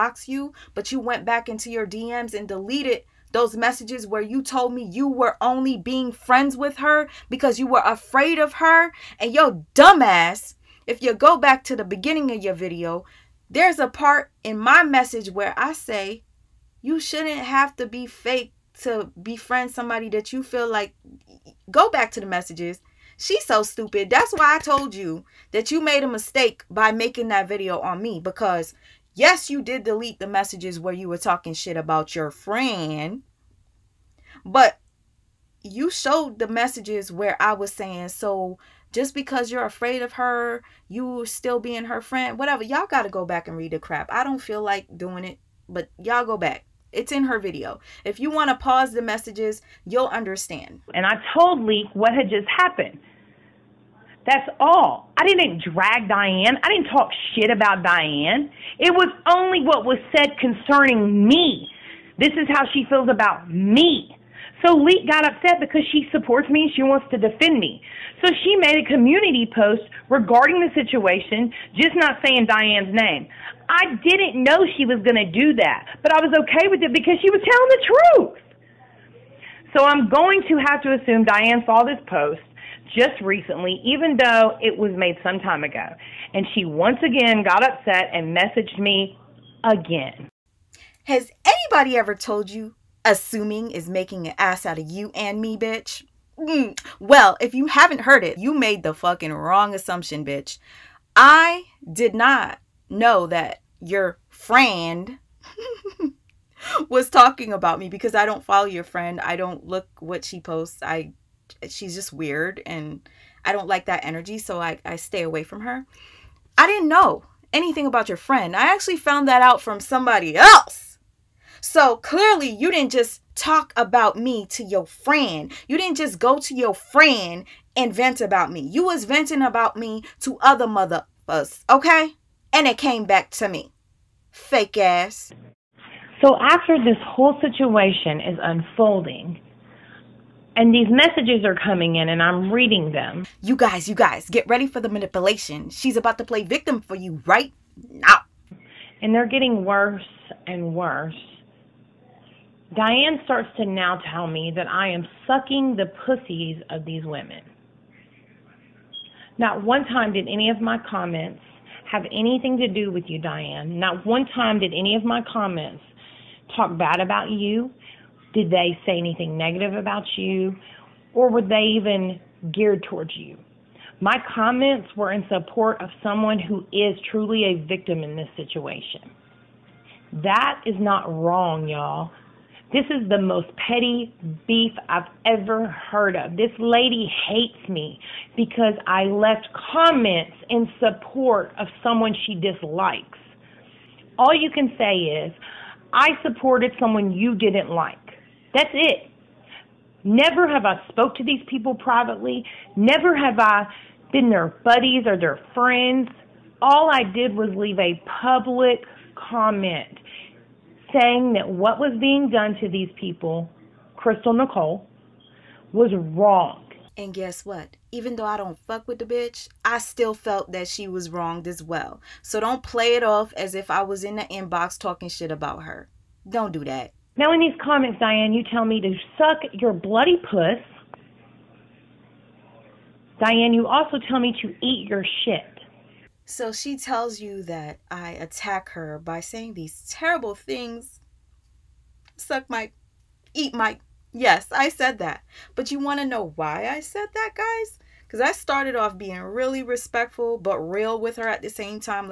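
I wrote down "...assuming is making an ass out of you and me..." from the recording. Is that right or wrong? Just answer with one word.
right.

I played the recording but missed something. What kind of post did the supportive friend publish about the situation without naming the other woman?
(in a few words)
community post.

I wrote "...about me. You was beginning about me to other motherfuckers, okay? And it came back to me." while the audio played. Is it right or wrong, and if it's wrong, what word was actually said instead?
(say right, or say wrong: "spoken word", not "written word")
wrong: "venting", not "beginning".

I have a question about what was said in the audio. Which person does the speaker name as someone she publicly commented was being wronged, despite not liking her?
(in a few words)
Crystal Nicole.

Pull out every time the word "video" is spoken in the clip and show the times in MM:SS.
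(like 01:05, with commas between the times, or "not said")
00:12, 00:27, 00:47.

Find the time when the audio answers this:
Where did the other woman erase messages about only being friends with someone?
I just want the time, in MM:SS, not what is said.
00:01.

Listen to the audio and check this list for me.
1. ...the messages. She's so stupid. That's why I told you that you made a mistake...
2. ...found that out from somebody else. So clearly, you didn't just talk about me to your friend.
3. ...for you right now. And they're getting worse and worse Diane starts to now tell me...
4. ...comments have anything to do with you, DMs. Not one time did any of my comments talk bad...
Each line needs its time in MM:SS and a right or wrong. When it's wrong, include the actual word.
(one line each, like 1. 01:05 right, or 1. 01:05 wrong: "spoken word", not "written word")
1. 00:22 right
2. 01:58 right
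3. 02:26 right
4. 02:40 wrong: "Diane", not "DMs".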